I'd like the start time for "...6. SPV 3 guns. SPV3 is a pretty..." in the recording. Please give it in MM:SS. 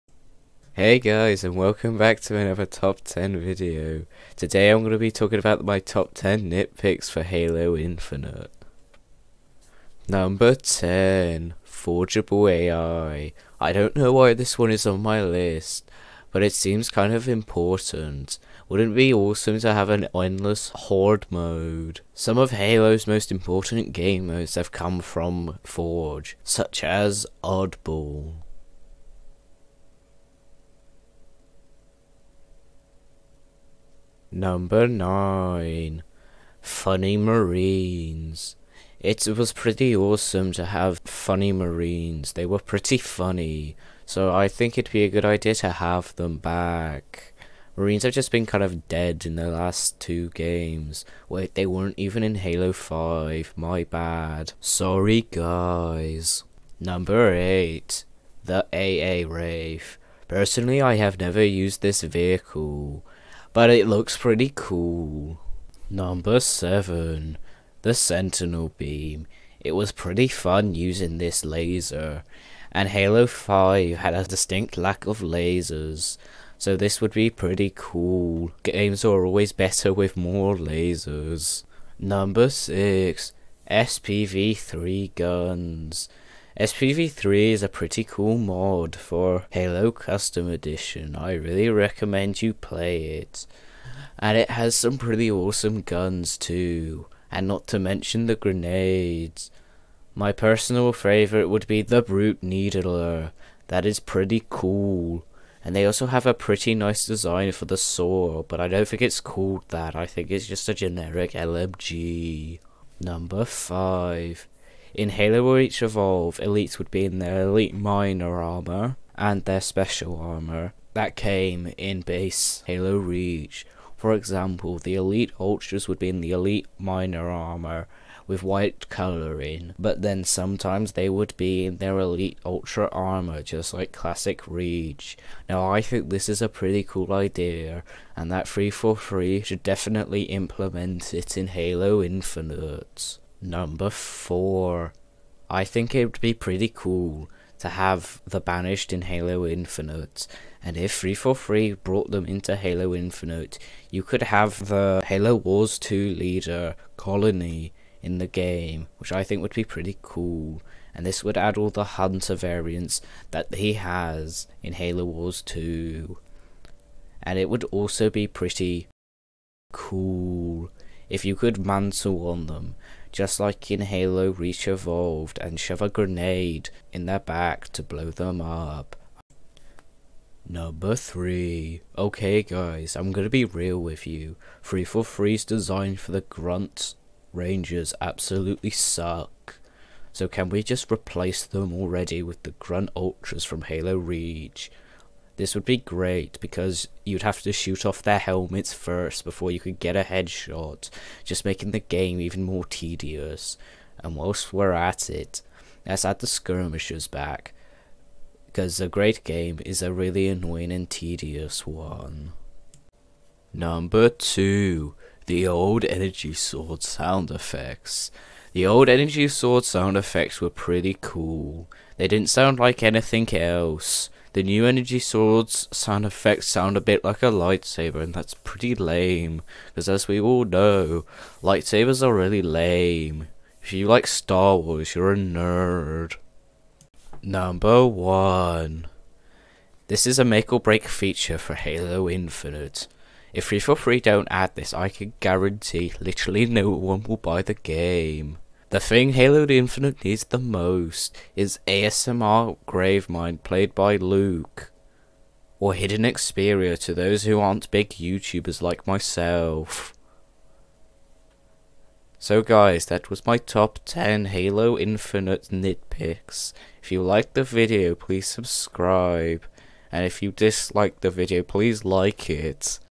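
01:22.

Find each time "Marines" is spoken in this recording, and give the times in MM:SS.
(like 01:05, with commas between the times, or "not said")
00:37, 00:41, 00:47.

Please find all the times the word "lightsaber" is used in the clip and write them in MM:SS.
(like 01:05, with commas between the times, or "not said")
03:47, 03:51.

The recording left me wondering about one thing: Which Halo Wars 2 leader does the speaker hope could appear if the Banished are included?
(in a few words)
Colony.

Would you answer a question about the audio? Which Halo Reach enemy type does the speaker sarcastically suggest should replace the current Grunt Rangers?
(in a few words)
Grunt Ultras.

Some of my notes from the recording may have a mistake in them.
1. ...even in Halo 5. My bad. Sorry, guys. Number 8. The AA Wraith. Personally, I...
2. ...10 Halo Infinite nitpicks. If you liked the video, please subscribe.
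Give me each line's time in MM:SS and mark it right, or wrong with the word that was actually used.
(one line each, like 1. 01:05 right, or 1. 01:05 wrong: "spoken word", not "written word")
1. 00:51 right
2. 04:23 right.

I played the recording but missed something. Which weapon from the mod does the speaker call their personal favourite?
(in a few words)
Brute Needler.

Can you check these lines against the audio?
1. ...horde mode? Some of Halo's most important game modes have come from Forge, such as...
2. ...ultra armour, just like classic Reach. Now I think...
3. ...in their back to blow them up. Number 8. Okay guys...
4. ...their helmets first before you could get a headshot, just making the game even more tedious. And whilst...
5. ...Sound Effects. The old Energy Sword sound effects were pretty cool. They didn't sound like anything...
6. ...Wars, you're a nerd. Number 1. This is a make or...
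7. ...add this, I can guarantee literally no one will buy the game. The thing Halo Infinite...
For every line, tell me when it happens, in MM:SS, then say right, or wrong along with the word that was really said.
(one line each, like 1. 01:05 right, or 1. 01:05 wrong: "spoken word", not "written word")
1. 00:20 right
2. 02:12 right
3. 02:56 wrong: "3", not "8"
4. 03:18 right
5. 03:36 right
6. 03:54 right
7. 04:04 right.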